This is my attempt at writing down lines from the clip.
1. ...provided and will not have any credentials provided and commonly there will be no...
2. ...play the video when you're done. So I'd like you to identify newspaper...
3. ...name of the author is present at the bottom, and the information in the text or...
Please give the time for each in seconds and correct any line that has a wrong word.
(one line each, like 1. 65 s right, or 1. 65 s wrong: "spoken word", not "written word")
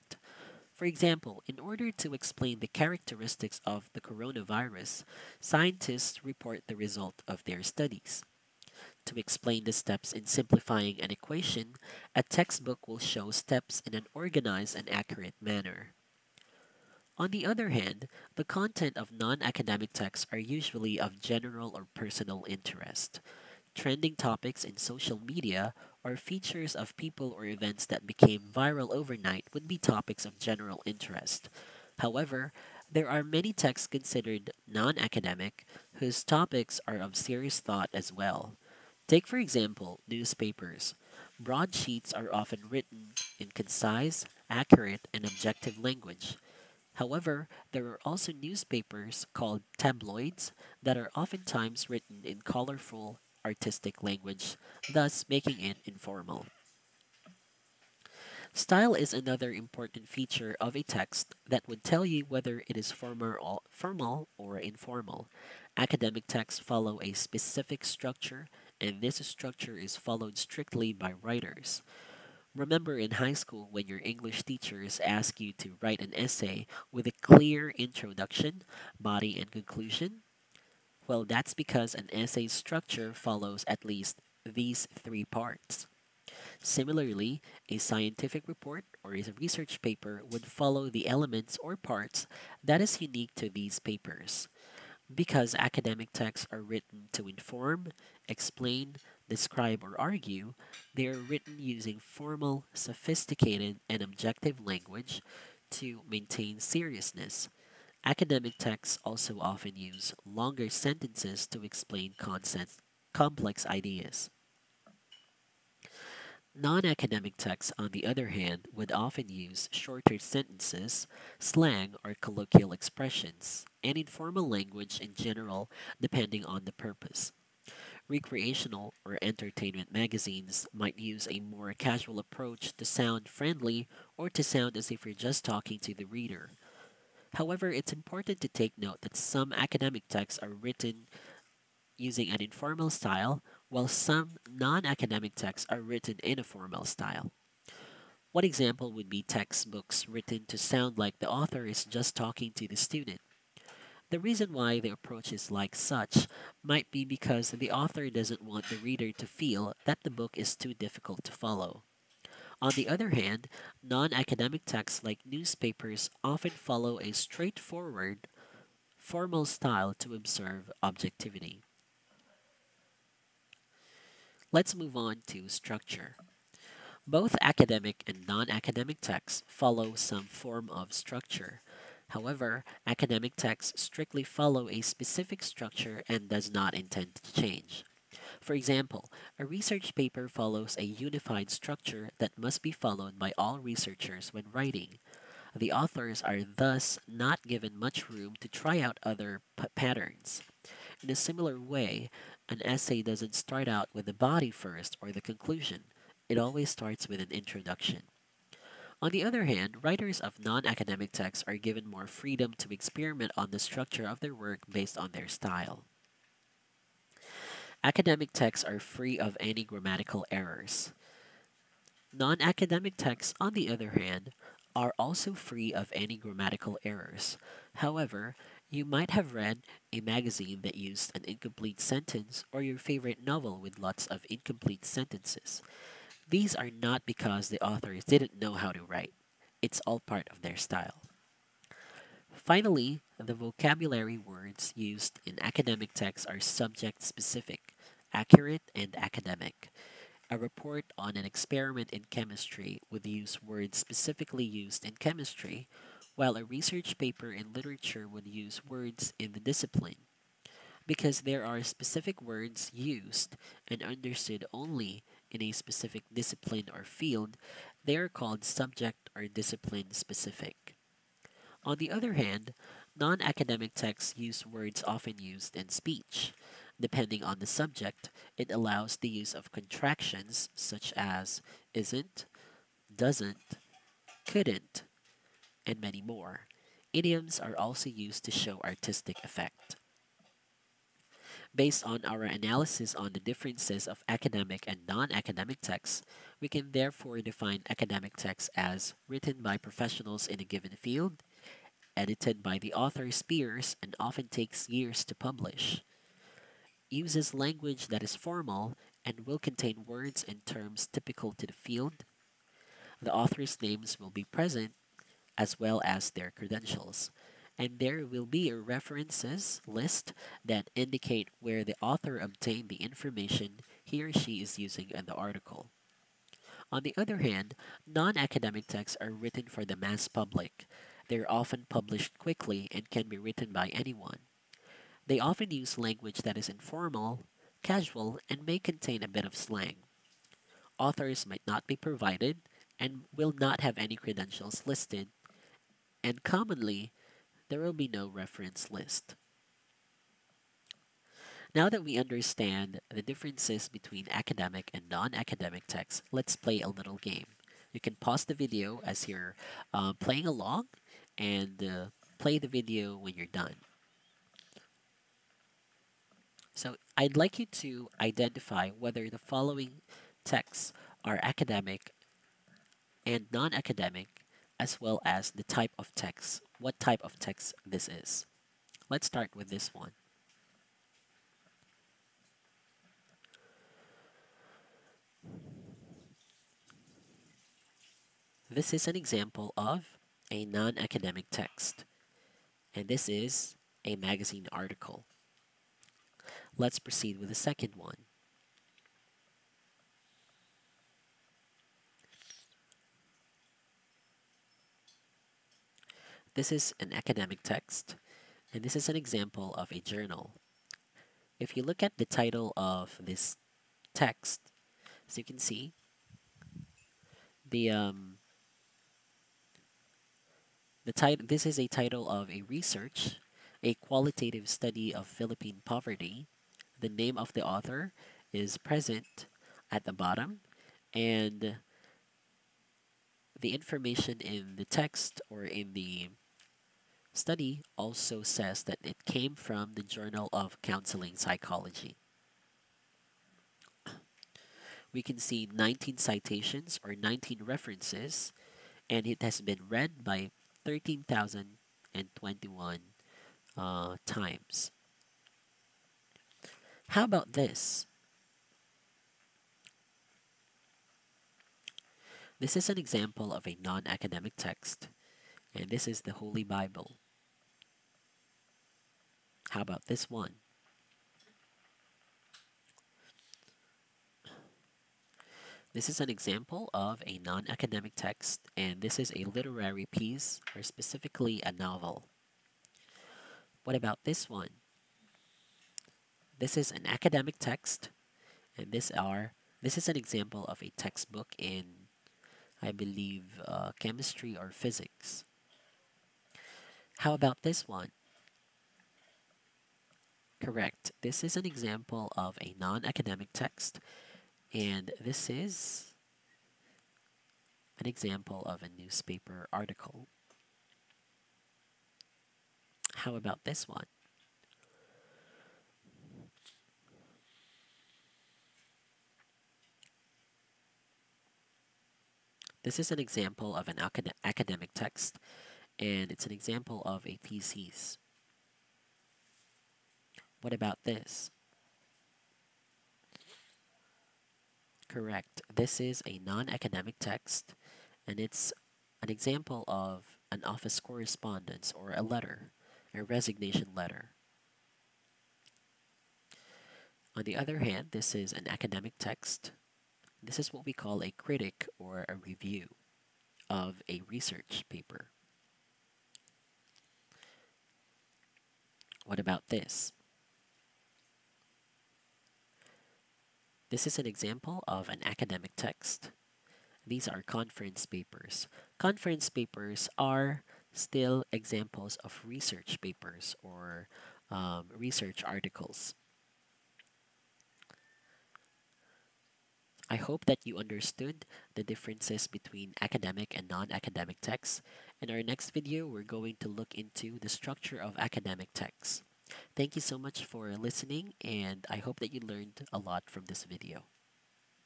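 1. 341 s wrong: "listed", not "provided"
2. 362 s wrong: "whether", not "newspaper"
3. 426 s right.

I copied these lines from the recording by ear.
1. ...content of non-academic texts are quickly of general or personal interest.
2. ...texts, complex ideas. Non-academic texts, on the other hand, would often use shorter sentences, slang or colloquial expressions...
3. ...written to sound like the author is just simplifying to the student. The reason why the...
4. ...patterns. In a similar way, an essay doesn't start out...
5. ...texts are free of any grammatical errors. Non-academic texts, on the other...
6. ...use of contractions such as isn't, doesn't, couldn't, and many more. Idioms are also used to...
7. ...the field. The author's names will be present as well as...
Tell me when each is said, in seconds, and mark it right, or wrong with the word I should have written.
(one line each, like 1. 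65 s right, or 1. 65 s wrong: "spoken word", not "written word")
1. 18 s wrong: "usually", not "quickly"
2. 112 s wrong: "concepts", not "texts"
3. 150 s wrong: "talking", not "simplifying"
4. 199 s right
5. 218 s right
6. 279 s right
7. 311 s right.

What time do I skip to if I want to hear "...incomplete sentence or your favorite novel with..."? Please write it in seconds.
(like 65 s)
231 s.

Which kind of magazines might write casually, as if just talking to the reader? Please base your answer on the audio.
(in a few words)
Recreational or entertainment magazines.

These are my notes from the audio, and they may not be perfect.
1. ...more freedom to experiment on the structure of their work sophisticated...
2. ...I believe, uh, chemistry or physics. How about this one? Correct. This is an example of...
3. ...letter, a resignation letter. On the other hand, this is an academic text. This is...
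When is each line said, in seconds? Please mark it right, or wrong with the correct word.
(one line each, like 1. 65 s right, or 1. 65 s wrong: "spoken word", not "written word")
1. 211 s wrong: "based", not "sophisticated"
2. 492 s right
3. 542 s right.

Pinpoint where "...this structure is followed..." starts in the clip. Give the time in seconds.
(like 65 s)
69 s.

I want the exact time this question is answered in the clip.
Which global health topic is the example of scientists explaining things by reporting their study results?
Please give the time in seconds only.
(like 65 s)
4 s.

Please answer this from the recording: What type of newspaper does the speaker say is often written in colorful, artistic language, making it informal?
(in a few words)
Tabloids.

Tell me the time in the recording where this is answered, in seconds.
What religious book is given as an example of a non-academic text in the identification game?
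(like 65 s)
466 s.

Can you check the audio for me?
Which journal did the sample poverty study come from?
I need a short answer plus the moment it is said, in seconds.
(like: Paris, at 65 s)
Journal of Counseling Psychology, at 439 s.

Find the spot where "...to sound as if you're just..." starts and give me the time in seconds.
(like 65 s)
134 s.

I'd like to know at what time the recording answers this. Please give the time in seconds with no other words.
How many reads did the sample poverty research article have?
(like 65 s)
450 s.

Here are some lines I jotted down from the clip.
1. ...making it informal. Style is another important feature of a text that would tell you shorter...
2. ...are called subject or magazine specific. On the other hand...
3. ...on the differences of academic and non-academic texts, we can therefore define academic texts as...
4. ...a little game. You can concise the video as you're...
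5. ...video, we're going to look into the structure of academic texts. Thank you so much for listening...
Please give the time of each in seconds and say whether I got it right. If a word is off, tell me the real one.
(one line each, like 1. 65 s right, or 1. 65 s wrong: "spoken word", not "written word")
1. 55 s wrong: "whether", not "shorter"
2. 267 s wrong: "discipline", not "magazine"
3. 292 s right
4. 356 s wrong: "pause", not "concise"
5. 585 s right.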